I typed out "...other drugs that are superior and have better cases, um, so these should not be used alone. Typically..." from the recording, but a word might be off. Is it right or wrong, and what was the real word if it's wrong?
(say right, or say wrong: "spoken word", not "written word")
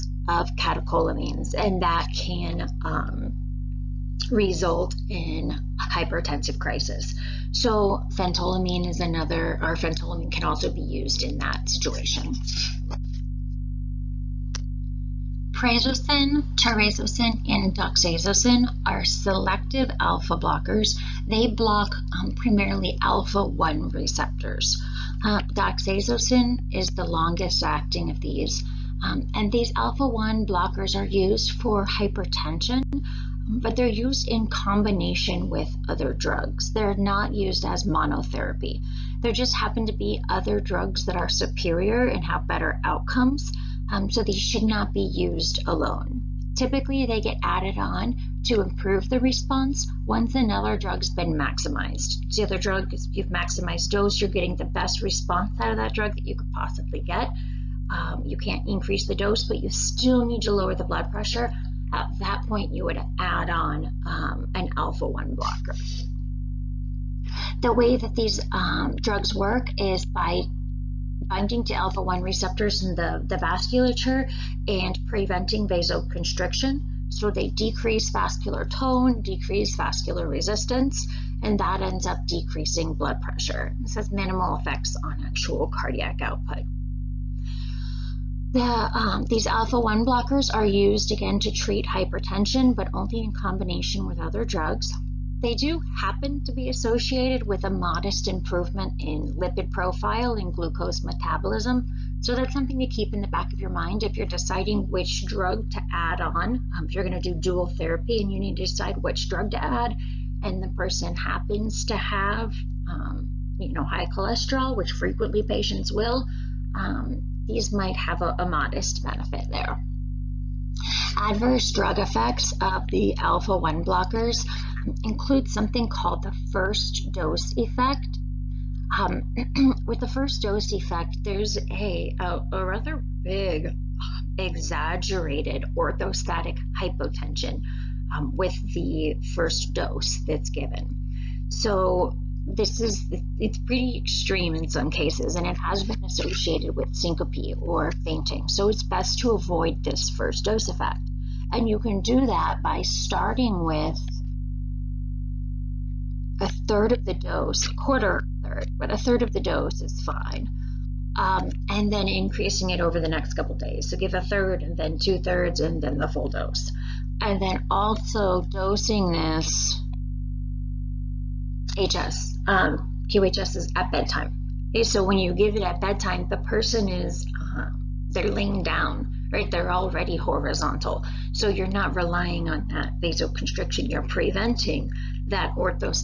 wrong: "outcomes", not "cases".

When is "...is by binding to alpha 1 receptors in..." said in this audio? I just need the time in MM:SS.
01:09.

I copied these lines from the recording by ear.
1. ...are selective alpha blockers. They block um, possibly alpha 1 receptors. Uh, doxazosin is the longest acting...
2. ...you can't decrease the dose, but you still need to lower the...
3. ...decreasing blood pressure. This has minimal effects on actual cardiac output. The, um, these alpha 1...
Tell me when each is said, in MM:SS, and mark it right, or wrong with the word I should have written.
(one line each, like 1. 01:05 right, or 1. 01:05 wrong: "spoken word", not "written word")
1. 00:18 wrong: "primarily", not "possibly"
2. 00:58 wrong: "increase", not "decrease"
3. 01:22 right.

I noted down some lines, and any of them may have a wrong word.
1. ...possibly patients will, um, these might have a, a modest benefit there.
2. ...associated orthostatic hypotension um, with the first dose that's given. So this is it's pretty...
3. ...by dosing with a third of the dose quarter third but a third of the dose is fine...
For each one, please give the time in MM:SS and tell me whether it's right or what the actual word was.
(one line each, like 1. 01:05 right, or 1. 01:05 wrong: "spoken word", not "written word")
1. 01:54 wrong: "frequently", not "possibly"
2. 02:14 wrong: "exaggerated", not "associated"
3. 02:32 wrong: "starting", not "dosing".